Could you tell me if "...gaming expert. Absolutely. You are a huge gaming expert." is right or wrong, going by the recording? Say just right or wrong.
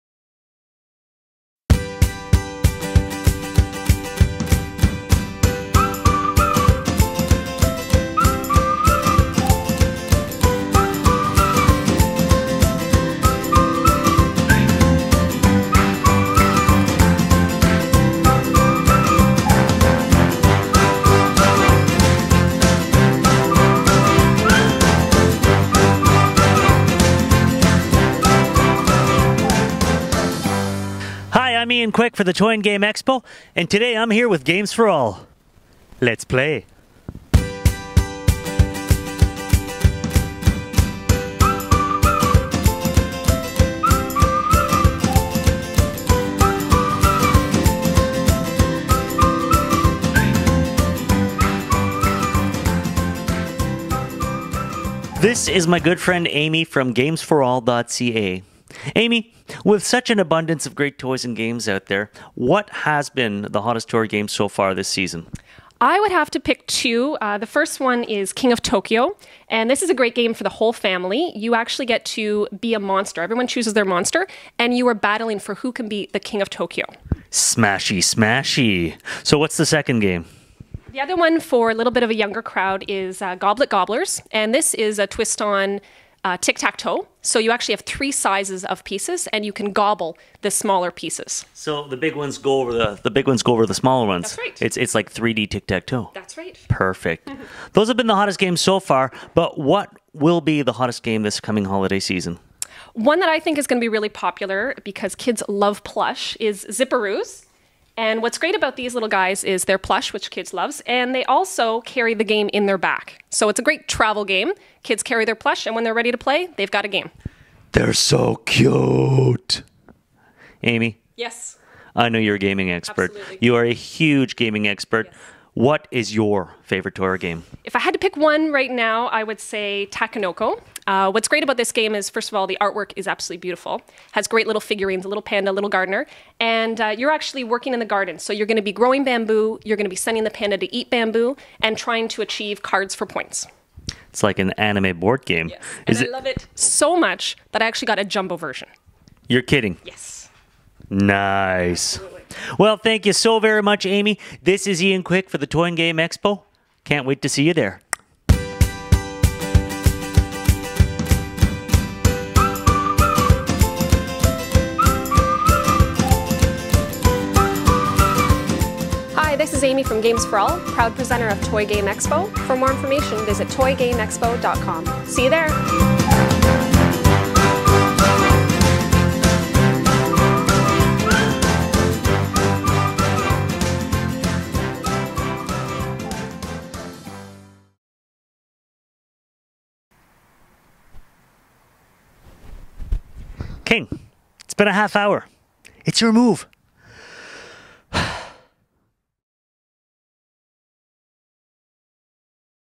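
right.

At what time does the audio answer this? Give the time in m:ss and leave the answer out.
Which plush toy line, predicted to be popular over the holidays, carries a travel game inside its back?
1:46.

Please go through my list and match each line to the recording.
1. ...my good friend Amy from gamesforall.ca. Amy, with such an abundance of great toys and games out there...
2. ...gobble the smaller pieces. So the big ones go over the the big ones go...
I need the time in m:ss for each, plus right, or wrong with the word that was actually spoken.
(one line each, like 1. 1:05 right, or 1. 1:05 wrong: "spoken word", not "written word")
1. 0:55 right
2. 1:29 right.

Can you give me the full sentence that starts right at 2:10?
Uh, what's great about this game is, first of all, the artwork is absolutely beautiful.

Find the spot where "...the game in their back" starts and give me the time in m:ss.
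1:52.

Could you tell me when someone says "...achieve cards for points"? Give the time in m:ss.
2:22.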